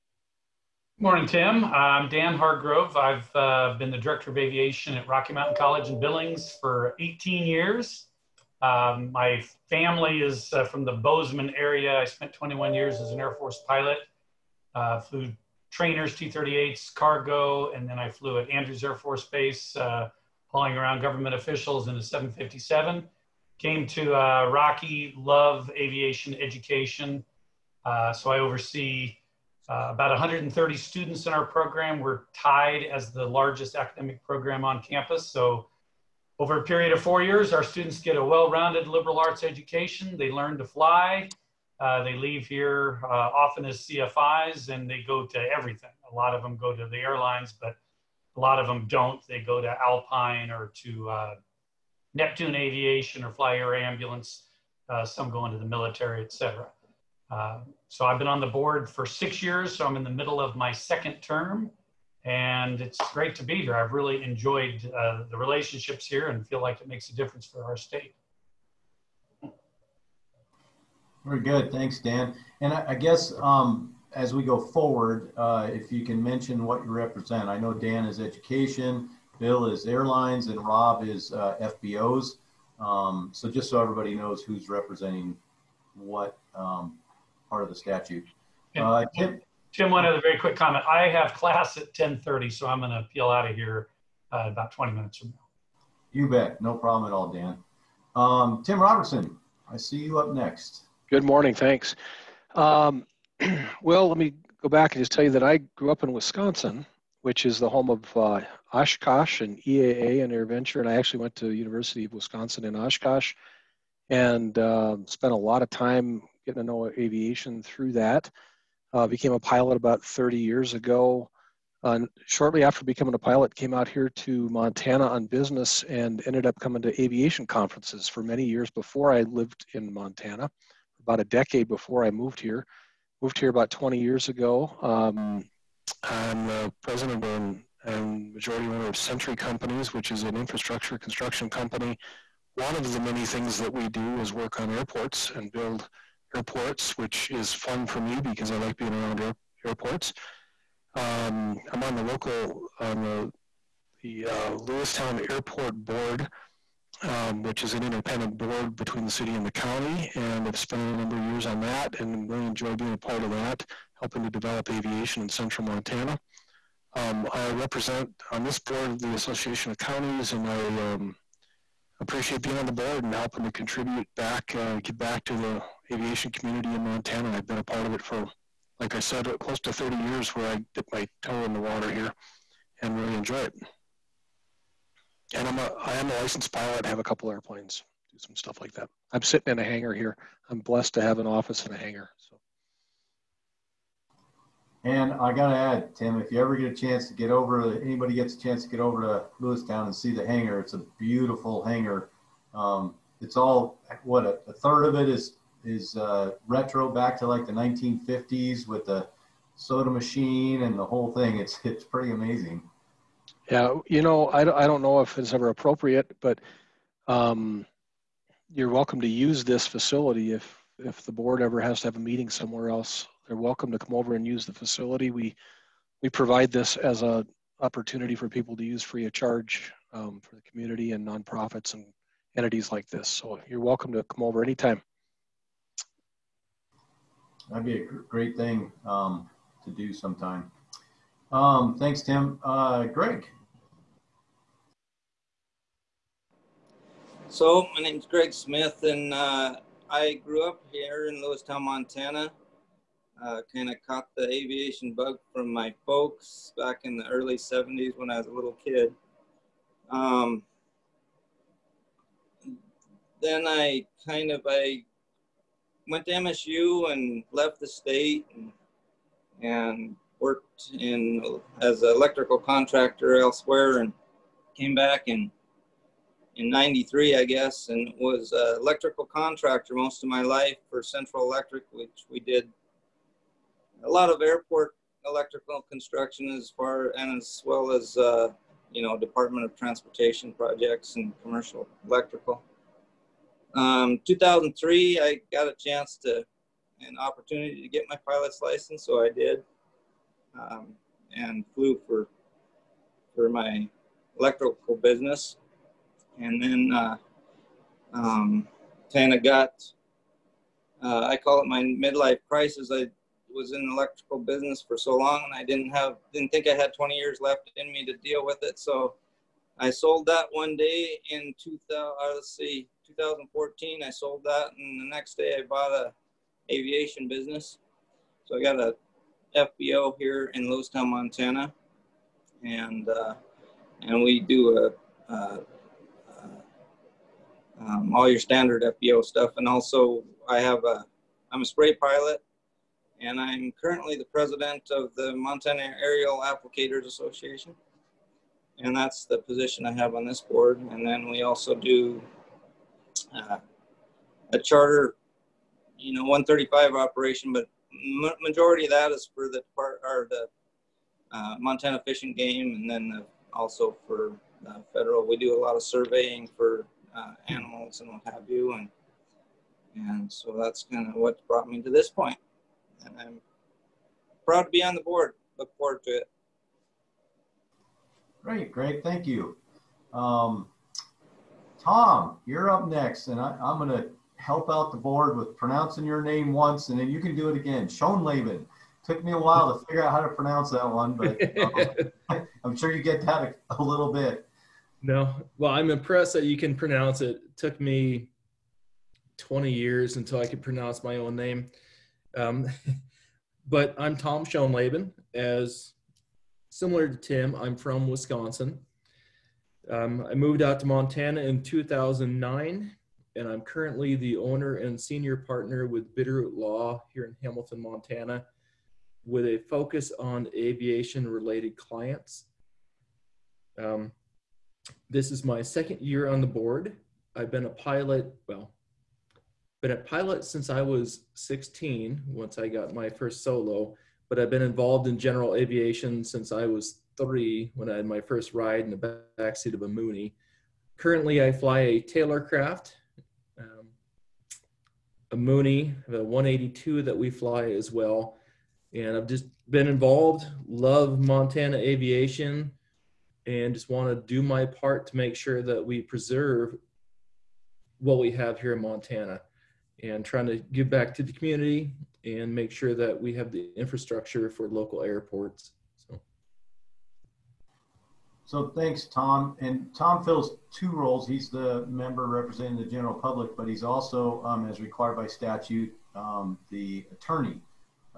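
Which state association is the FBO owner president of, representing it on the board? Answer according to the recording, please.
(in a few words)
Montana Aerial Applicators Association.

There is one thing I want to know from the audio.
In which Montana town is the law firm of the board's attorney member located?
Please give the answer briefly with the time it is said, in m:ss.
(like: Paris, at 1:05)
Hamilton, at 6:57.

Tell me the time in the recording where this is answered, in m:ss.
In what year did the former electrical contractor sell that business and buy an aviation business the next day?
5:22.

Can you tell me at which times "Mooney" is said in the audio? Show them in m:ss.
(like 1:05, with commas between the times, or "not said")
7:19, 7:25.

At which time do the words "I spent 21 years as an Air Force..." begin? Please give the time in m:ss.
0:11.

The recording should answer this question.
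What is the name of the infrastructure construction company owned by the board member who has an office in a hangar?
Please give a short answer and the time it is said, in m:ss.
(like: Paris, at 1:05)
Century Companies, at 2:18.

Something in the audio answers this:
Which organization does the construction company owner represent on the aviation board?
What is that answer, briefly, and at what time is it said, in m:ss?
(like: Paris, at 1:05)
Association of Counties, at 2:49.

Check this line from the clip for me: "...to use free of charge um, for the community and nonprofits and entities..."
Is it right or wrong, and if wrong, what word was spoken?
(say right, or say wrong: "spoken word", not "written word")
right.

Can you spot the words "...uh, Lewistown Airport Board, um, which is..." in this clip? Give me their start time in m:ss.
2:34.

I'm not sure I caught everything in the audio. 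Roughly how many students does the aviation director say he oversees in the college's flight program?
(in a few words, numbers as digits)
130.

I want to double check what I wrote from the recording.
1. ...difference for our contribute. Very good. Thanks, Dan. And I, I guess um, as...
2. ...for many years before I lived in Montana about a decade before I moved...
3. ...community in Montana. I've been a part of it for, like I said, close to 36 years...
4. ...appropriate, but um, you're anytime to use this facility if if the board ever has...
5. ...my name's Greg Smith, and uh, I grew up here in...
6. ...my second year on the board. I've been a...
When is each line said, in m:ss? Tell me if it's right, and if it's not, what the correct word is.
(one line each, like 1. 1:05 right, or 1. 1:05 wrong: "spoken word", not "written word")
1. 1:07 wrong: "state", not "contribute"
2. 2:08 right
3. 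2:56 wrong: "30", not "36"
4. 3:35 wrong: "welcome", not "anytime"
5. 4:07 right
6. 7:05 right.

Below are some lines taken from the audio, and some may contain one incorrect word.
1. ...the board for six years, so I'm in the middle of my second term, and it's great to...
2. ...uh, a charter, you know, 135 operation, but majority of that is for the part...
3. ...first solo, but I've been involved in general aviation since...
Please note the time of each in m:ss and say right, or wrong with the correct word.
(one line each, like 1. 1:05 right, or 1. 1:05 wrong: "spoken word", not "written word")
1. 0:58 right
2. 5:53 right
3. 7:12 right.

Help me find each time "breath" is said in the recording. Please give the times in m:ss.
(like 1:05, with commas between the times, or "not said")
not said.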